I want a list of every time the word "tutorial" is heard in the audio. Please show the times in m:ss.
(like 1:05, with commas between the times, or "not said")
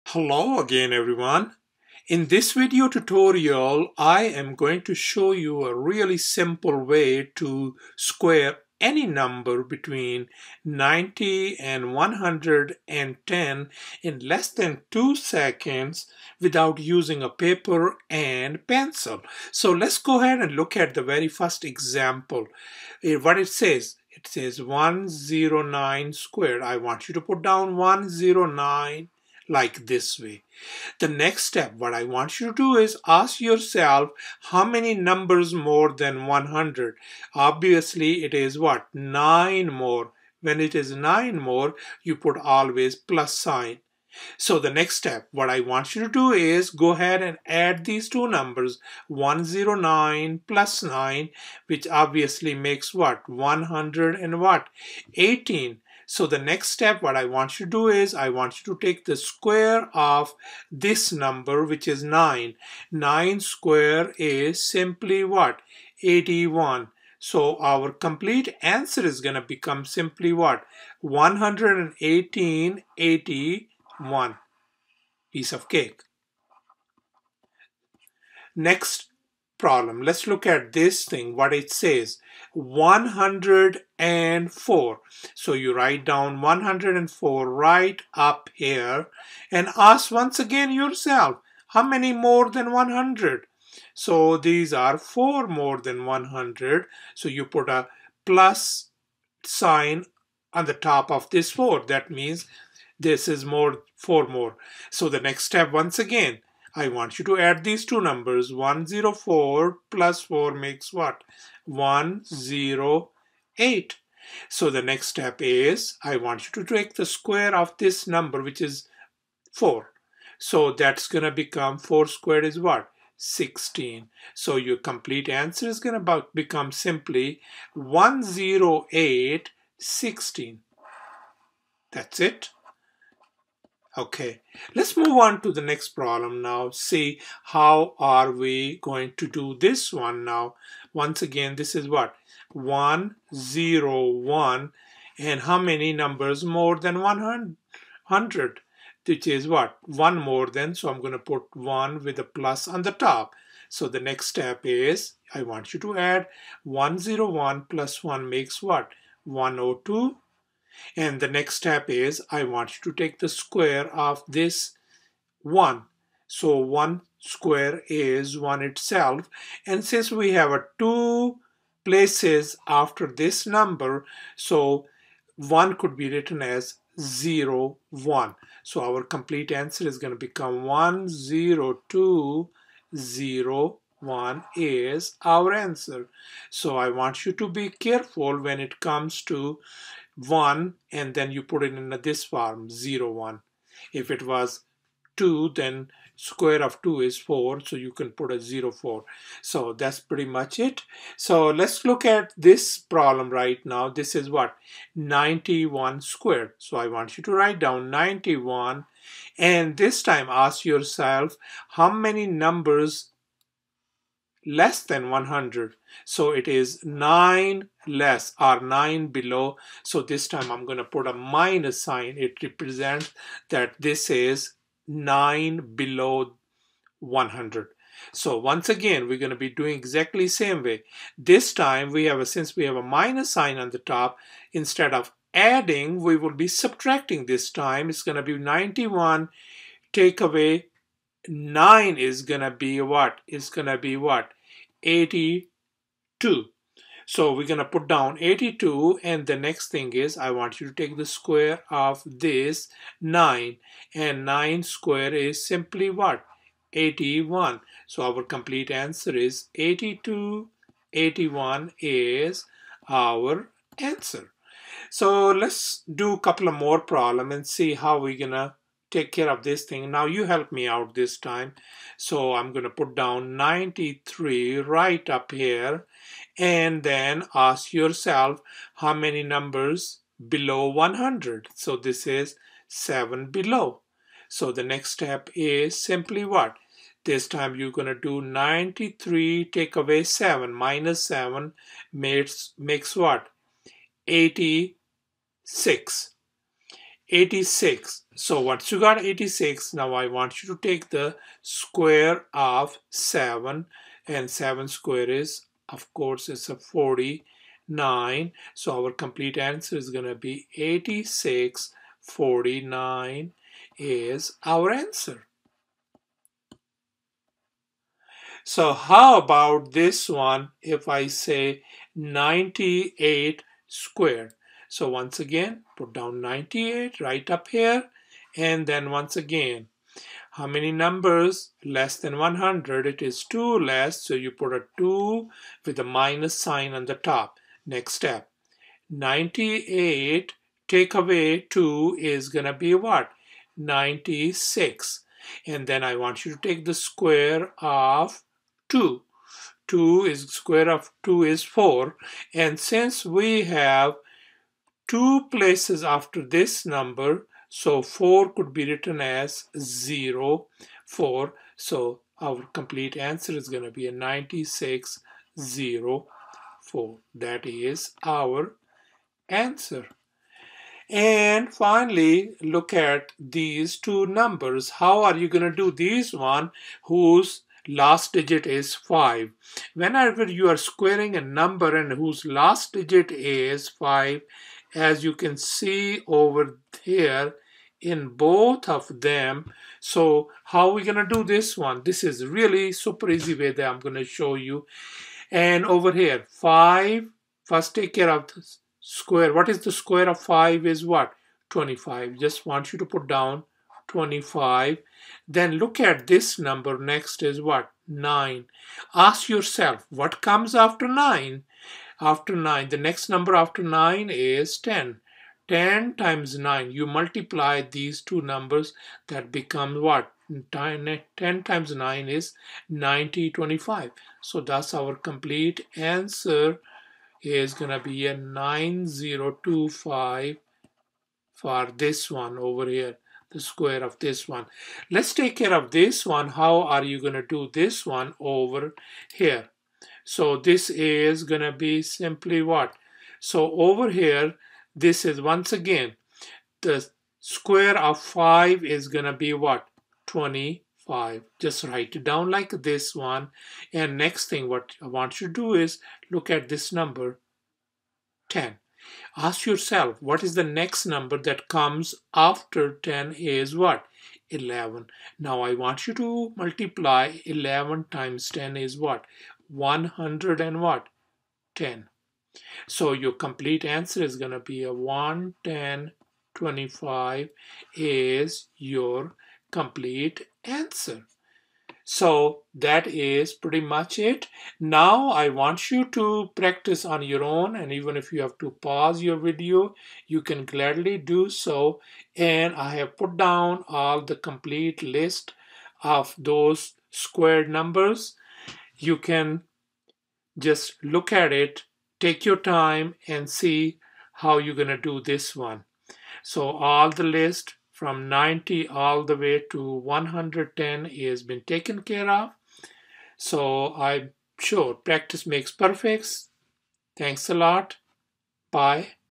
0:02.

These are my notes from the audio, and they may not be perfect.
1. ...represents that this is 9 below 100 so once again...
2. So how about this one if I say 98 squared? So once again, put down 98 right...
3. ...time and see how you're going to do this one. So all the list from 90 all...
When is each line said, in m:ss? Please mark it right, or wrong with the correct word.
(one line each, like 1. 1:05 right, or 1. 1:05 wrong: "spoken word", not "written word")
1. 3:42 right
2. 5:18 right
3. 8:22 right.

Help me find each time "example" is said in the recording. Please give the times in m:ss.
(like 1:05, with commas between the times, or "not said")
0:21.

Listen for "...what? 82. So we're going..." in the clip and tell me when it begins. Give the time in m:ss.
4:03.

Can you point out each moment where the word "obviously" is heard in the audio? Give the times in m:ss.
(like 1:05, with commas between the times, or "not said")
0:37, 0:51.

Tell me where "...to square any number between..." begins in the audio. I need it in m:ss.
0:07.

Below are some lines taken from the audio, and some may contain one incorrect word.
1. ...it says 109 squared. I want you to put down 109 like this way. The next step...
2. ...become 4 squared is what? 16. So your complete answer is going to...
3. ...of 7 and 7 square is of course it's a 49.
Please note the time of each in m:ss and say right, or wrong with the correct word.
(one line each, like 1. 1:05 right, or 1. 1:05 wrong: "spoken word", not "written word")
1. 0:24 right
2. 2:01 right
3. 5:02 right.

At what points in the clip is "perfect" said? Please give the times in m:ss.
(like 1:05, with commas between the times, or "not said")
8:35.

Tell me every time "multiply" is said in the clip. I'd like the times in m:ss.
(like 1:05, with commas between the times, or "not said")
6:56, 7:46.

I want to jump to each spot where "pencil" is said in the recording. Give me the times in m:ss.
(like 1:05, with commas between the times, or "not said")
0:18.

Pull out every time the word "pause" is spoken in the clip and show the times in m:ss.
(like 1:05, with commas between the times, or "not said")
8:08.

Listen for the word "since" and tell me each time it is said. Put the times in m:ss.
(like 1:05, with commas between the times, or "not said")
2:49, 3:52, 5:52.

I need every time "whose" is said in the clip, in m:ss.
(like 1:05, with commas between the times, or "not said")
6:16, 6:21.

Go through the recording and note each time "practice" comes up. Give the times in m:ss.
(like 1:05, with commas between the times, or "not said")
8:06, 8:34.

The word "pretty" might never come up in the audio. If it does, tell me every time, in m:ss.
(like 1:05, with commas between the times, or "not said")
3:20, 8:03.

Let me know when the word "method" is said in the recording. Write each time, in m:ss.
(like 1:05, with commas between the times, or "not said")
not said.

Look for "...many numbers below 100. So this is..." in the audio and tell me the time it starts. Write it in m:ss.
4:38.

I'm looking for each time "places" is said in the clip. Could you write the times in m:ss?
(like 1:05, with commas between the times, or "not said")
2:51, 5:55.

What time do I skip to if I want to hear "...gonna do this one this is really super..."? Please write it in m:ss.
6:30.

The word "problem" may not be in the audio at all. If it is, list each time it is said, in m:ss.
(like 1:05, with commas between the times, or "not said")
1:19, 2:15, 3:22, 4:26.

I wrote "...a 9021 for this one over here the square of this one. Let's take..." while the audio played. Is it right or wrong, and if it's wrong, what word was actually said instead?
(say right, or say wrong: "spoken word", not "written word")
wrong: "9025", not "9021".